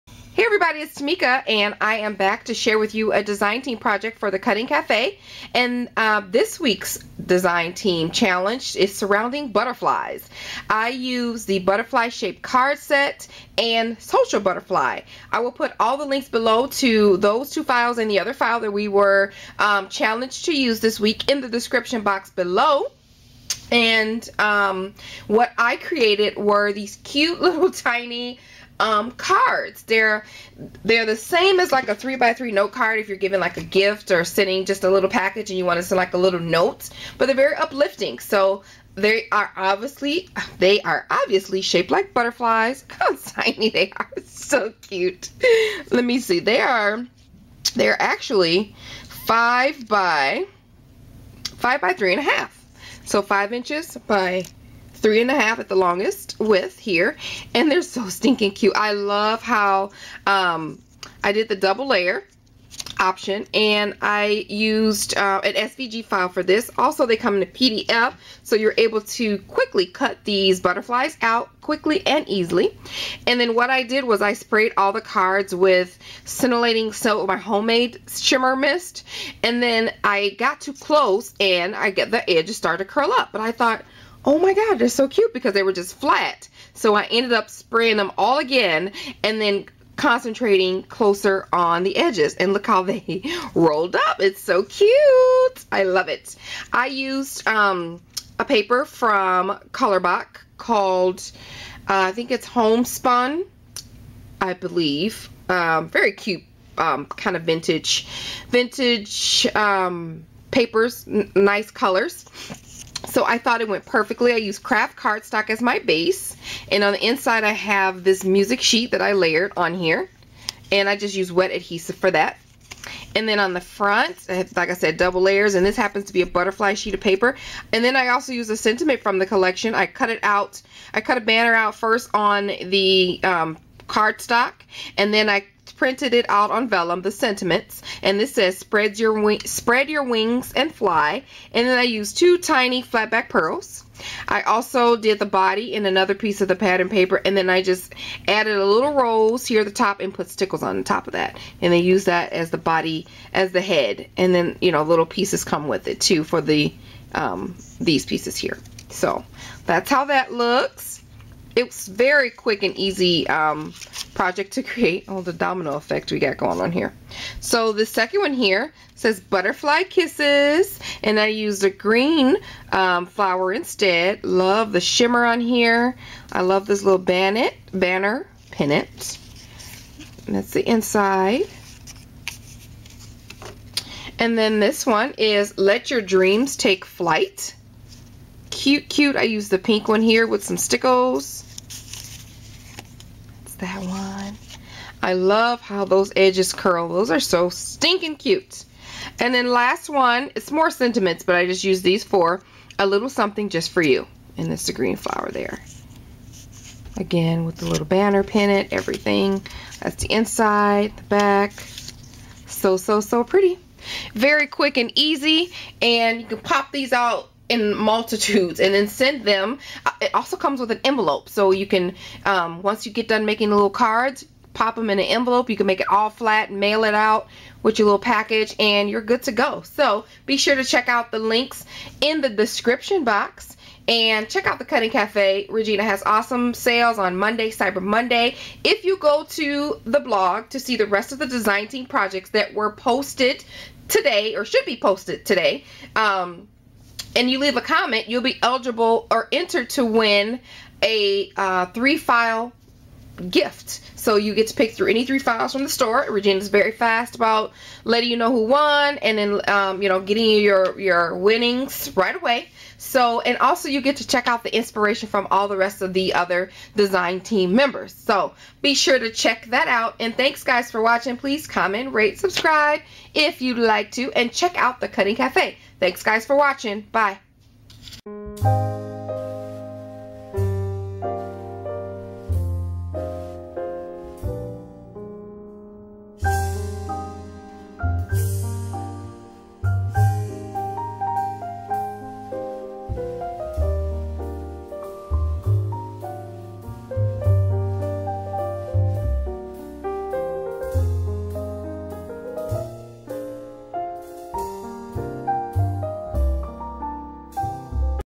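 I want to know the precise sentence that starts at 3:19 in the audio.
And then last one, it's more sentiments, but I just use these for A little something just for you.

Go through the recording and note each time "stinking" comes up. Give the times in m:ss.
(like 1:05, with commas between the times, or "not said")
0:58, 3:17.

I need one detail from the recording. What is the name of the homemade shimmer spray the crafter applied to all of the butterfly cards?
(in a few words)
Scintillating Soap.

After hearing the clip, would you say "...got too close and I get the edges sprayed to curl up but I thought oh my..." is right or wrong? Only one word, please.
wrong.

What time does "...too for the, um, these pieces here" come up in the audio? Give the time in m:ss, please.
2:35.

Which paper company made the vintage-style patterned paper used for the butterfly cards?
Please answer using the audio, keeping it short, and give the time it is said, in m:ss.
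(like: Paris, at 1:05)
Colorbok, at 1:39.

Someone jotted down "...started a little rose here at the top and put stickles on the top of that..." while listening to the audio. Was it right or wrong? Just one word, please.
wrong.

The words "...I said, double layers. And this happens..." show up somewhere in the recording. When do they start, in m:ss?
2:04.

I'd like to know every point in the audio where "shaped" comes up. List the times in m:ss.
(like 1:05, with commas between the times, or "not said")
0:12, 0:41.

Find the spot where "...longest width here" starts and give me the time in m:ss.
0:55.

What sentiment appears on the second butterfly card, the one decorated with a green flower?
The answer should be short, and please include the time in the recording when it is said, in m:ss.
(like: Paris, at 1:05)
Butterfly Kisses, at 2:49.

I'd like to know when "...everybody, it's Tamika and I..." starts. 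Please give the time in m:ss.
0:00.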